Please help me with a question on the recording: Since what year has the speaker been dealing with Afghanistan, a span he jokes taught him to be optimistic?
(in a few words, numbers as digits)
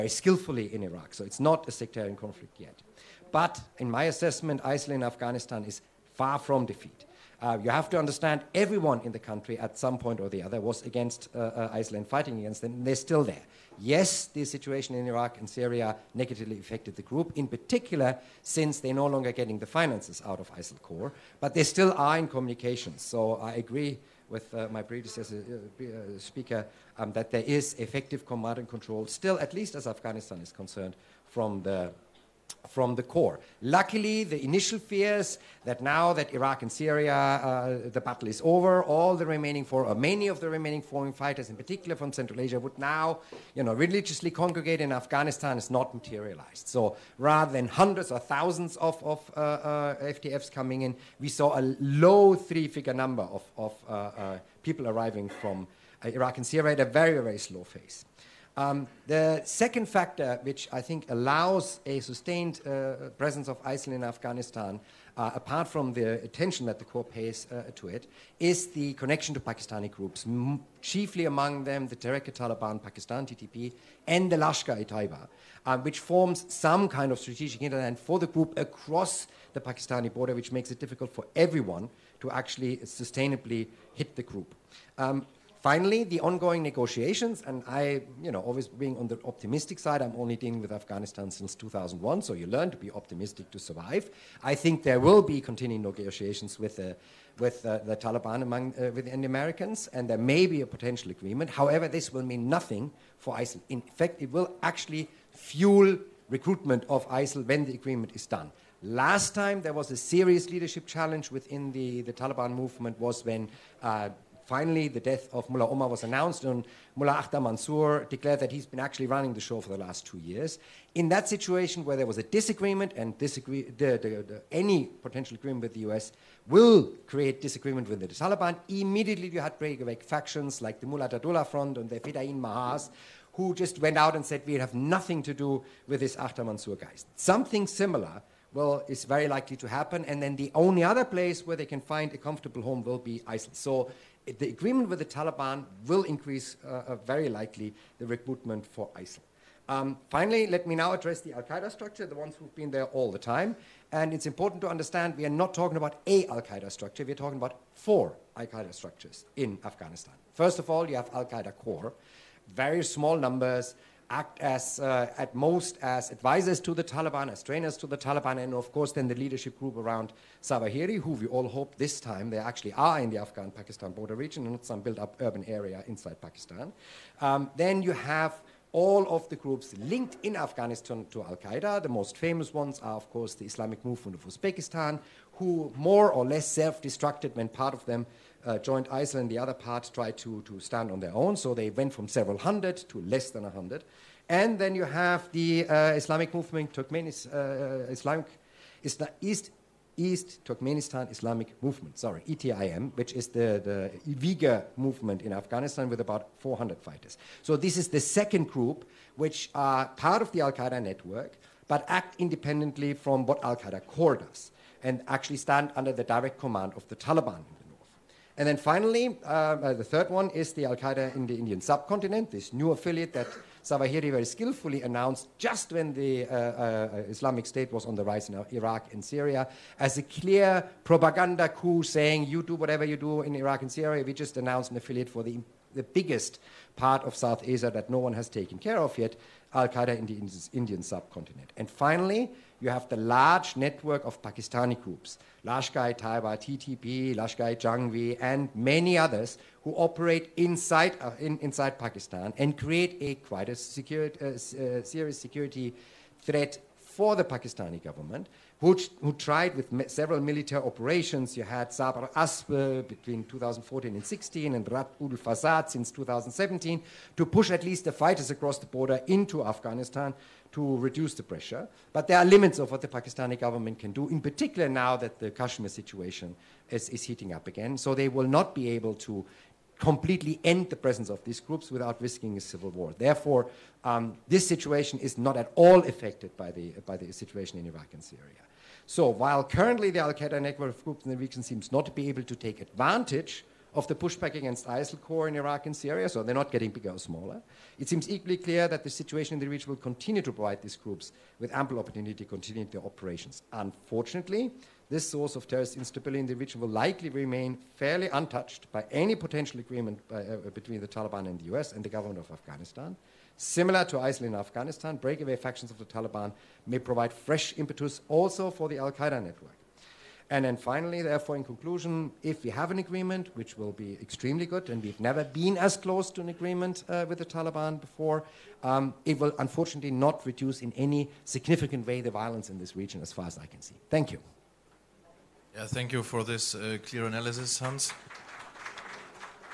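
2001.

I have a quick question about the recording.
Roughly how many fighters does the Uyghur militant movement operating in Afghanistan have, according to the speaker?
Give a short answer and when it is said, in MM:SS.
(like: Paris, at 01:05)
400, at 03:26.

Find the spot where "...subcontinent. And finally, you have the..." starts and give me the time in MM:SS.
04:00.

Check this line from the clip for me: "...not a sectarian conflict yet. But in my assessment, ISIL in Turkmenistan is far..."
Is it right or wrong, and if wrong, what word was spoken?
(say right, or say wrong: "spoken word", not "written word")
wrong: "Afghanistan", not "Turkmenistan".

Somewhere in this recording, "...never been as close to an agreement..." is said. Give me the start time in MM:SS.
05:24.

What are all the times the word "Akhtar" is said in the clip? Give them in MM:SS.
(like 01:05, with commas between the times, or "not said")
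01:57, 02:16.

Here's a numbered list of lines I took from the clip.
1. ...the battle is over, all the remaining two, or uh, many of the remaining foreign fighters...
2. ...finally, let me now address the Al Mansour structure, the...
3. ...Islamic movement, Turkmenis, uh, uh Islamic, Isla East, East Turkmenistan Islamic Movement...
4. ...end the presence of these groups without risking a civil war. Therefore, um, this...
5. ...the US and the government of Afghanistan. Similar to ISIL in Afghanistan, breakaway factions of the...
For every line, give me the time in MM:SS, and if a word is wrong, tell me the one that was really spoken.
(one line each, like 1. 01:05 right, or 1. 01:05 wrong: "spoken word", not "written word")
1. 00:37 wrong: "four", not "two"
2. 02:30 wrong: "Qaeda", not "Mansour"
3. 03:15 right
4. 04:40 right
5. 05:11 right.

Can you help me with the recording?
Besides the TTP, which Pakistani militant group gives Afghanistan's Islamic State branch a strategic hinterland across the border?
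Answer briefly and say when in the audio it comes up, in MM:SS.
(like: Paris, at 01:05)
Lashkar-e-Taiba, at 01:14.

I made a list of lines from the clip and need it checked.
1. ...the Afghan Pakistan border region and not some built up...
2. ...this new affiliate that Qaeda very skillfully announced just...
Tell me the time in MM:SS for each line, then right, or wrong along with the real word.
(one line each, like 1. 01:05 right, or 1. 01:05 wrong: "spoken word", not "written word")
1. 02:53 right
2. 03:42 wrong: "Zawahiri", not "Qaeda".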